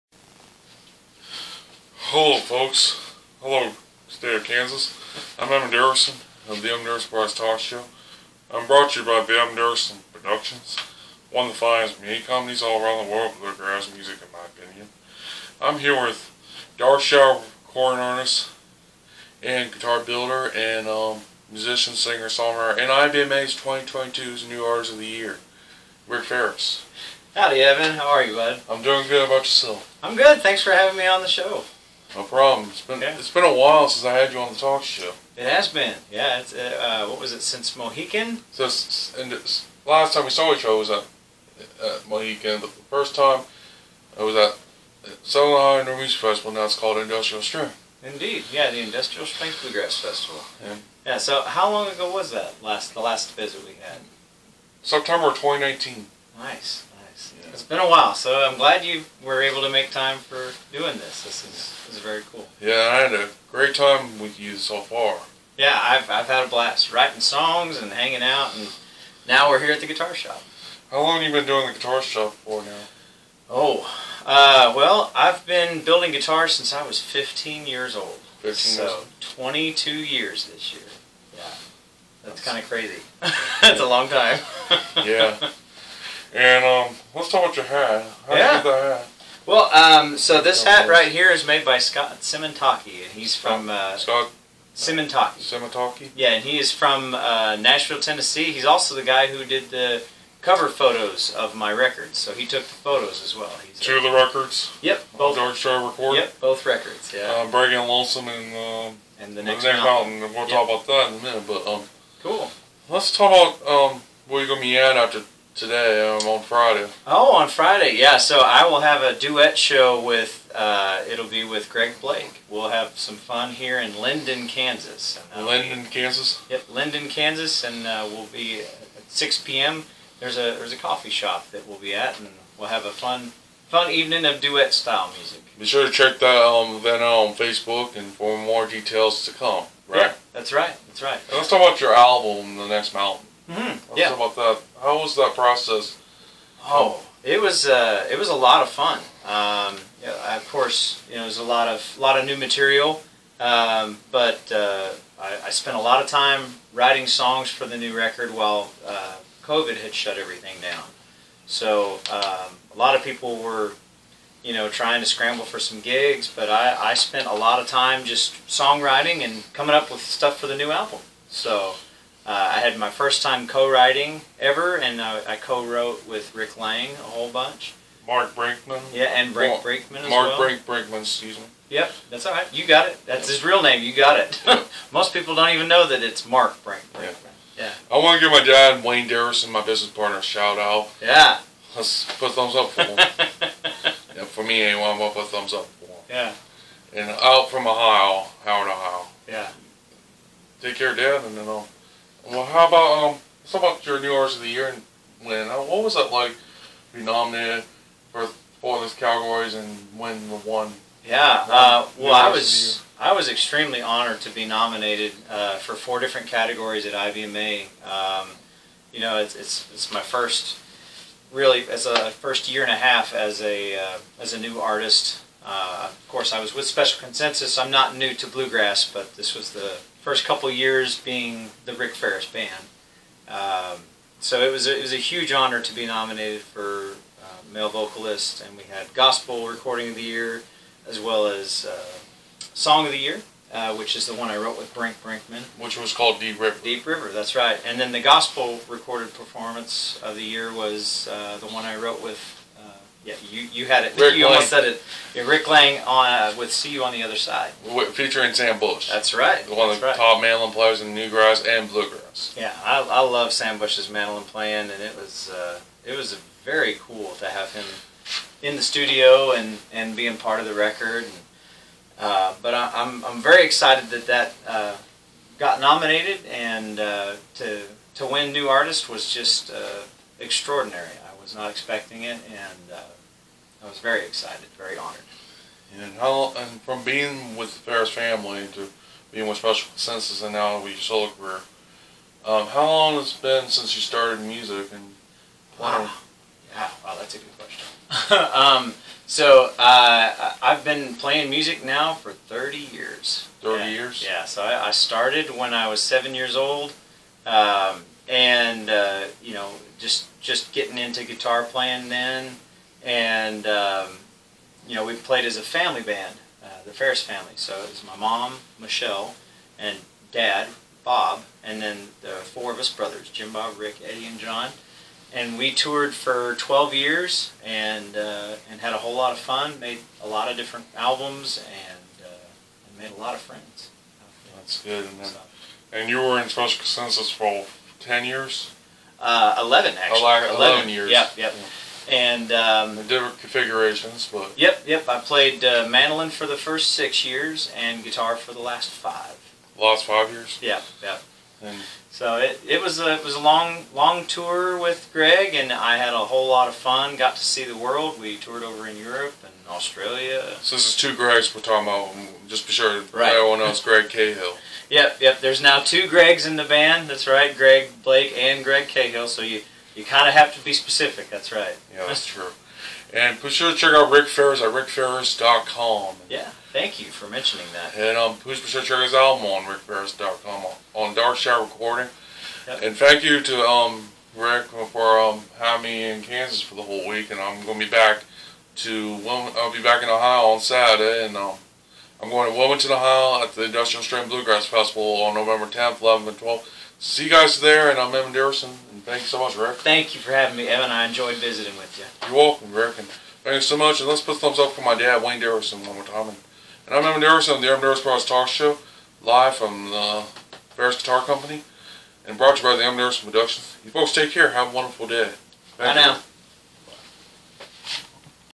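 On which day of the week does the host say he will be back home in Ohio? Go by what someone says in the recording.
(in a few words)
Saturday.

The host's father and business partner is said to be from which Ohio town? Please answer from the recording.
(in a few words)
Howard, Ohio.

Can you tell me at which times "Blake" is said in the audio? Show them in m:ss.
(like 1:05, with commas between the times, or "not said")
2:02, 6:07.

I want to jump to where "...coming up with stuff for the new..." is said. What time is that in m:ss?
2:49.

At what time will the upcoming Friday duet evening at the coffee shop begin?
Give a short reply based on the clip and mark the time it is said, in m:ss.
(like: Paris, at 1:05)
6 p.m., at 2:09.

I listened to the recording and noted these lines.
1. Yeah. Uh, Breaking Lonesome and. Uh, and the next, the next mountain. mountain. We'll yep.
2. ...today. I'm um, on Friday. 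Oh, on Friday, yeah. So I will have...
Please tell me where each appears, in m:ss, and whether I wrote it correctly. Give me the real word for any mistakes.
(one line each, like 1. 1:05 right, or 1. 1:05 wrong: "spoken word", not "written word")
1. 1:47 right
2. 1:55 right.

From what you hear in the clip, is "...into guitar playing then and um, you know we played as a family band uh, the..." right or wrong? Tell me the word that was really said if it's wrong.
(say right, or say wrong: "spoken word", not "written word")
right.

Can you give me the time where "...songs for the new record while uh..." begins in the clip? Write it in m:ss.
2:37.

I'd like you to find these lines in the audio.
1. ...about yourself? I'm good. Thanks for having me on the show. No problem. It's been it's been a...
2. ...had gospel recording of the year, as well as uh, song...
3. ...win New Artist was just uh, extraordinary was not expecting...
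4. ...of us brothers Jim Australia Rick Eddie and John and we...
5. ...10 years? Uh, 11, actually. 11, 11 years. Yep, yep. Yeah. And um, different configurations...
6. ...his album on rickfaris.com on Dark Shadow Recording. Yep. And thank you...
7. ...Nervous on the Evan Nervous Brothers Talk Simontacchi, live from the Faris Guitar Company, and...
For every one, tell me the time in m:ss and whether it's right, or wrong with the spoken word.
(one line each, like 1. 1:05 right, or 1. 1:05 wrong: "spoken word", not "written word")
1. 0:29 right
2. 3:58 right
3. 4:38 right
4. 5:22 wrong: "Bob", not "Australia"
5. 5:37 right
6. 6:18 right
7. 6:47 wrong: "Show", not "Simontacchi".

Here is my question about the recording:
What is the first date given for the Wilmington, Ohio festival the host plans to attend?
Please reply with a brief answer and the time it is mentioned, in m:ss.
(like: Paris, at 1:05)
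November 10, at 6:35.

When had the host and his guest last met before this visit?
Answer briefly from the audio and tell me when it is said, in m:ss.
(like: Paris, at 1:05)
September 2019, at 0:54.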